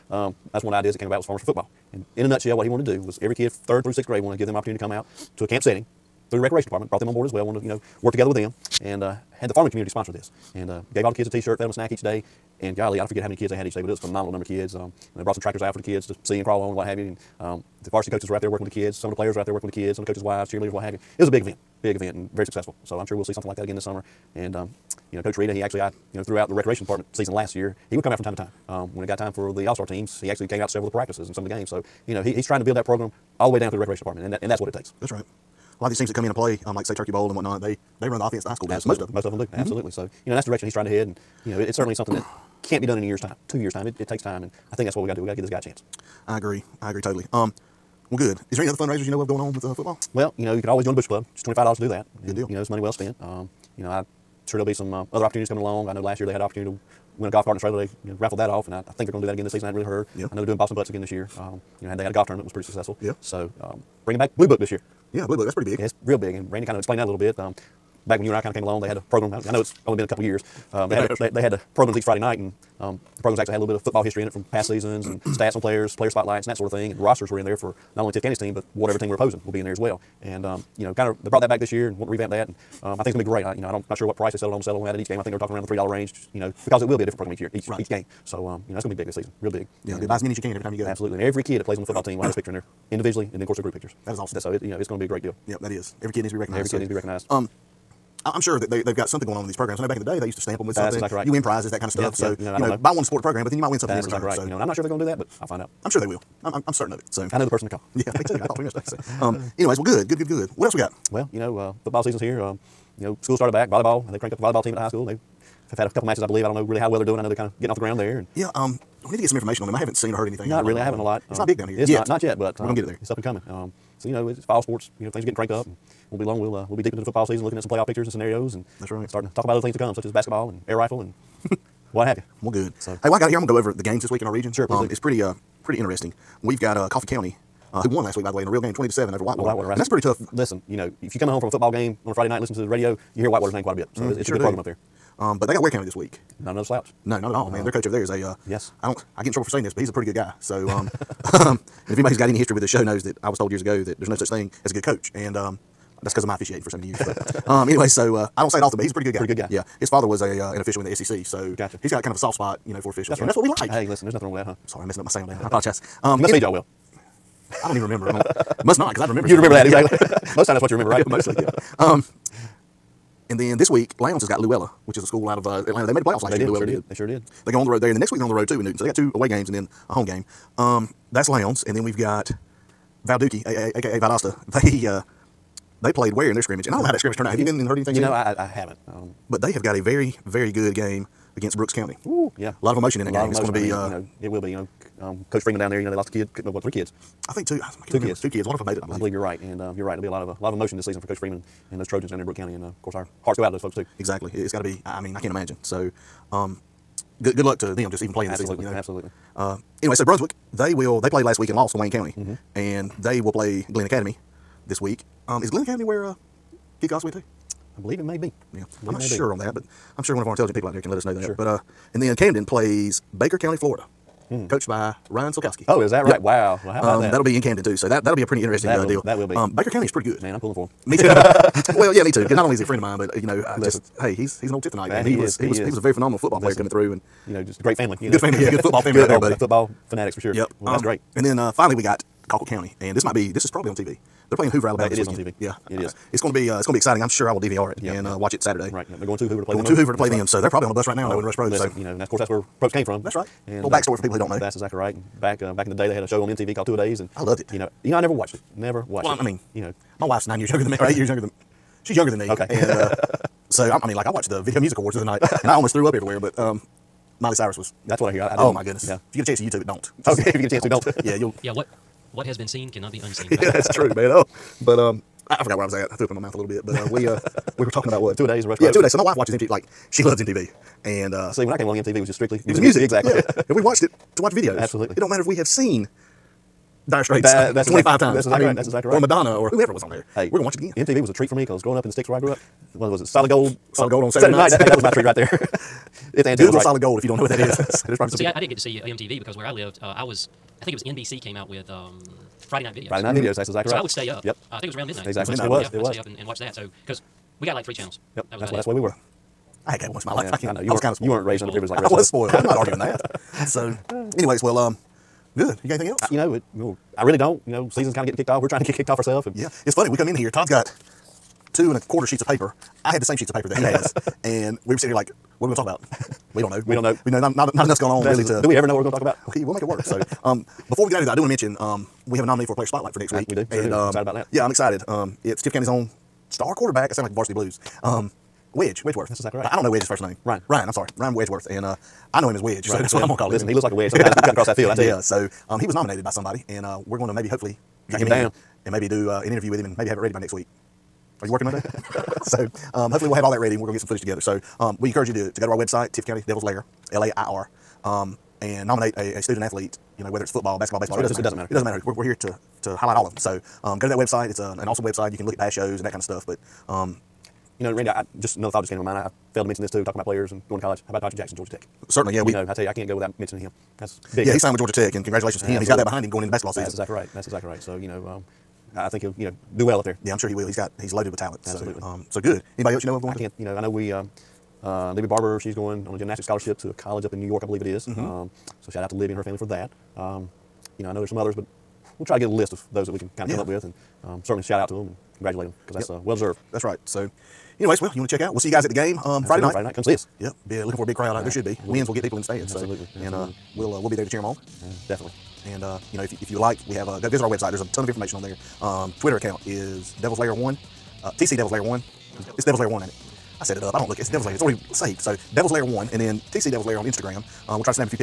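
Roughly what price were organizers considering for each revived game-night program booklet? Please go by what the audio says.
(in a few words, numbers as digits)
$3.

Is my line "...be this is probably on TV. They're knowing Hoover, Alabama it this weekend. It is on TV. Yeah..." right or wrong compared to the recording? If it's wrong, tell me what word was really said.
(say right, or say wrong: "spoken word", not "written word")
wrong: "playing", not "knowing".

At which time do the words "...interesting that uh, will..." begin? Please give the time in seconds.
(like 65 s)
228 s.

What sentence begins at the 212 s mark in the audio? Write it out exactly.
and they will play Glynn Academy this week.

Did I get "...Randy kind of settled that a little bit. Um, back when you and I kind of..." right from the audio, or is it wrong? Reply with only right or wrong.
wrong.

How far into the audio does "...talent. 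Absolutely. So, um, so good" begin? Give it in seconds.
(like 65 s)
381 s.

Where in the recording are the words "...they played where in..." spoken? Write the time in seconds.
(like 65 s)
185 s.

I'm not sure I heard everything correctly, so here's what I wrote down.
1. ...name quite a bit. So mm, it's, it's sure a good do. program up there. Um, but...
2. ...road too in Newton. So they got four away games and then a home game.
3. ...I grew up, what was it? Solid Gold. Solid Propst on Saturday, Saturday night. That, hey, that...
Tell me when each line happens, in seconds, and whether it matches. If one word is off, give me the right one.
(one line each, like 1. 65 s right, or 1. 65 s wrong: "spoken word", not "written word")
1. 143 s right
2. 178 s wrong: "two", not "four"
3. 292 s wrong: "Gold", not "Propst".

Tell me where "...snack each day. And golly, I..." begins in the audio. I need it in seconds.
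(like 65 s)
11 s.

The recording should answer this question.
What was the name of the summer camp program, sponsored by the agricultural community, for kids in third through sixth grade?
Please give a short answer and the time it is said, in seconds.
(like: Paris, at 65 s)
Farmers for Football, at 1 s.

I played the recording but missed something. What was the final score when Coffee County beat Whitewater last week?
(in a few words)
20 to 7.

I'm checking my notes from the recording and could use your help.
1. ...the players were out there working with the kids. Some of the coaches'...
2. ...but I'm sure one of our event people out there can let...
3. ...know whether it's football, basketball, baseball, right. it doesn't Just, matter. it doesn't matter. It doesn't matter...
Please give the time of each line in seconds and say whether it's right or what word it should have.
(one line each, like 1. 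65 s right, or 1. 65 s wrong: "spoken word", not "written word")
1. 19 s right
2. 219 s wrong: "intelligent", not "event"
3. 360 s right.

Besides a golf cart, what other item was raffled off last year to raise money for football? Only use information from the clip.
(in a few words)
A trailer.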